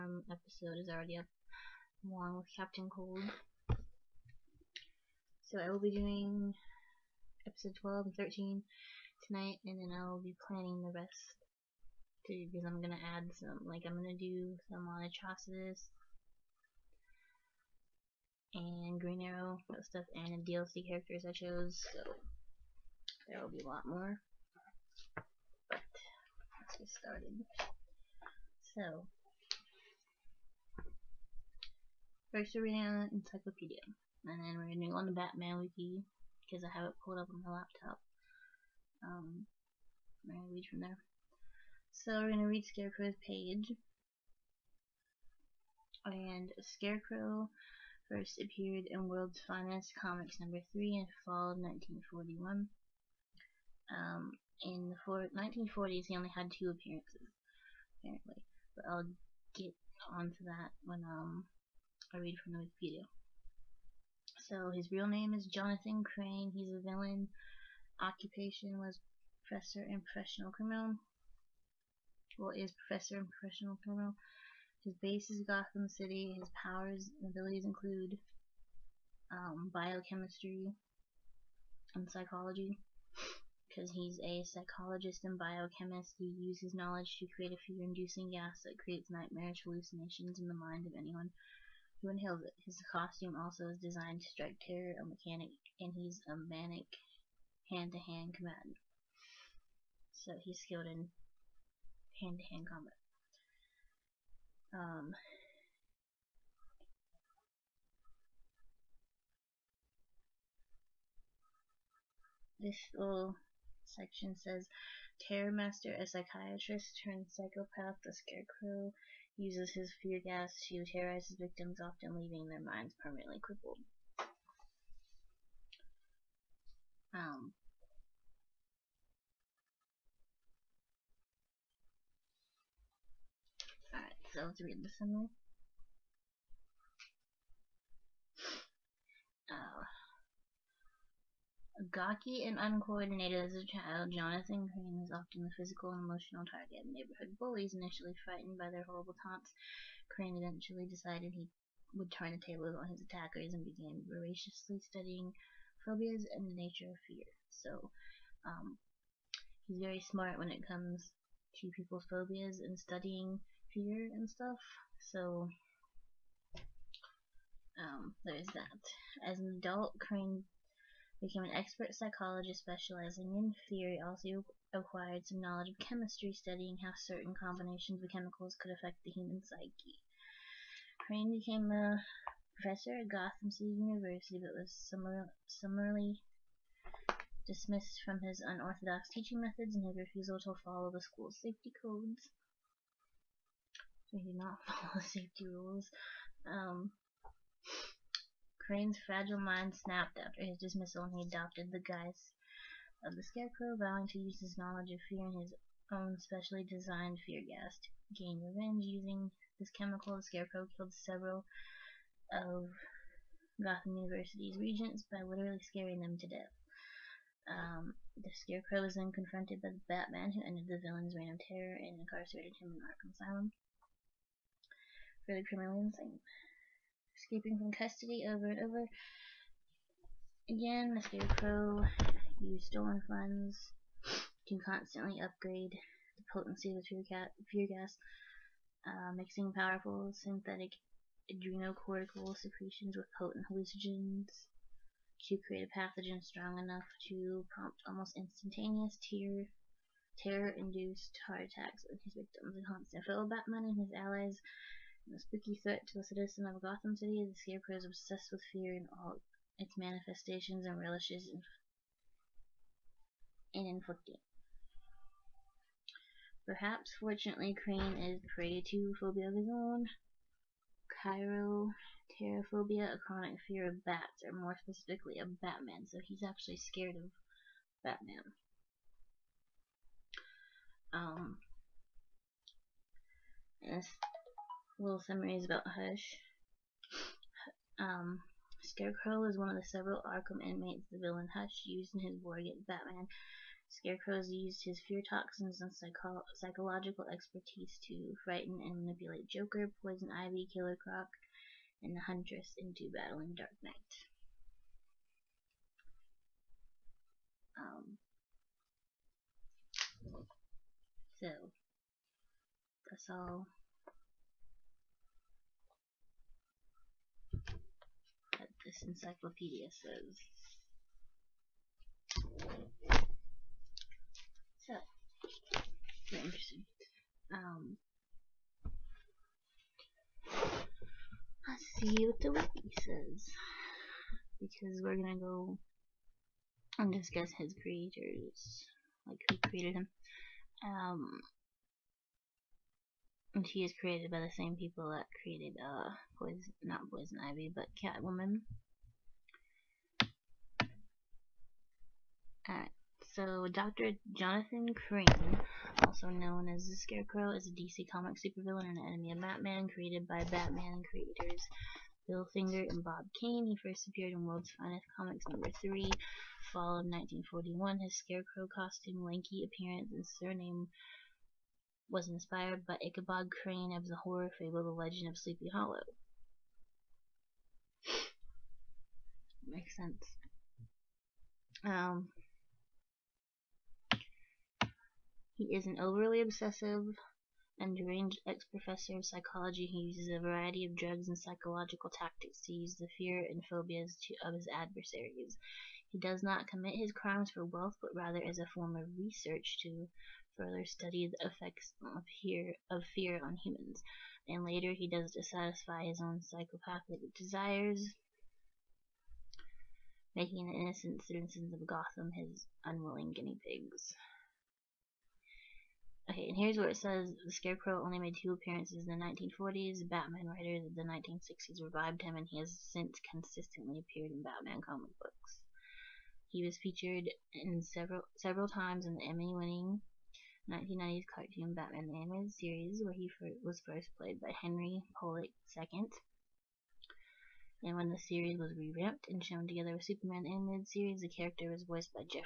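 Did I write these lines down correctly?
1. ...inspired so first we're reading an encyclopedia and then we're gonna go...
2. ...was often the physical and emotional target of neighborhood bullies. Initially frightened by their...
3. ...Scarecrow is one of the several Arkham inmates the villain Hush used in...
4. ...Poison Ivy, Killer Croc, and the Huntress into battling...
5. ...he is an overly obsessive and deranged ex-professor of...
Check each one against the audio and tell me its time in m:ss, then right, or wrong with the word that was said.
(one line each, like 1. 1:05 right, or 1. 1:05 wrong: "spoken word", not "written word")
1. 0:26 wrong: "started", not "inspired"
2. 2:24 right
3. 4:48 right
4. 4:59 right
5. 6:25 right.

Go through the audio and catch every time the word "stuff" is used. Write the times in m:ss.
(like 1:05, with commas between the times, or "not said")
0:19, 2:44.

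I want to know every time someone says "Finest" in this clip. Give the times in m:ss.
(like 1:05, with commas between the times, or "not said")
0:49, 6:04.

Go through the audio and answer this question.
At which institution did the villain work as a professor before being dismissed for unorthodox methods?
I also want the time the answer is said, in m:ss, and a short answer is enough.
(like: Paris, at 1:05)
Gotham City University, at 3:03.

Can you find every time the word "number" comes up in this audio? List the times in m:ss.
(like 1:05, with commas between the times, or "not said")
0:50, 6:05.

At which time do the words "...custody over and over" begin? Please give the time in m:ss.
3:47.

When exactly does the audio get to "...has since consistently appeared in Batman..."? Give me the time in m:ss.
7:02.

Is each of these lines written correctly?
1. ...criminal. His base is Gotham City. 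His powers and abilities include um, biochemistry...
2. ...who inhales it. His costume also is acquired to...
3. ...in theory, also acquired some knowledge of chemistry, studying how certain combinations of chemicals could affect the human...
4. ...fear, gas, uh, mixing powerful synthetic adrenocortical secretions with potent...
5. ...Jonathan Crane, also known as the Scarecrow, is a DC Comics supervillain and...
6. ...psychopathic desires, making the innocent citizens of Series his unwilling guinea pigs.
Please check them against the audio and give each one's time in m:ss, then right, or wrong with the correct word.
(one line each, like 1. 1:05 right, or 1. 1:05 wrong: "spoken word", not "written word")
1. 1:13 right
2. 1:32 wrong: "designed", not "acquired"
3. 2:53 right
4. 3:57 right
5. 5:54 right
6. 6:46 wrong: "Gotham", not "Series".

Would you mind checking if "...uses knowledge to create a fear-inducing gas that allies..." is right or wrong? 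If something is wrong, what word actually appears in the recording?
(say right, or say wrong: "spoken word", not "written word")
wrong: "creates", not "allies".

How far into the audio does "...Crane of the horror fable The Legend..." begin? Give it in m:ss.
6:13.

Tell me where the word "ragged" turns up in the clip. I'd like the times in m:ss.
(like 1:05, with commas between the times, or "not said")
not said.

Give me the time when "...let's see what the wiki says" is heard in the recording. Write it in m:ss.
5:31.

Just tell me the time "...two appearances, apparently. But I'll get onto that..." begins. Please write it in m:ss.
0:56.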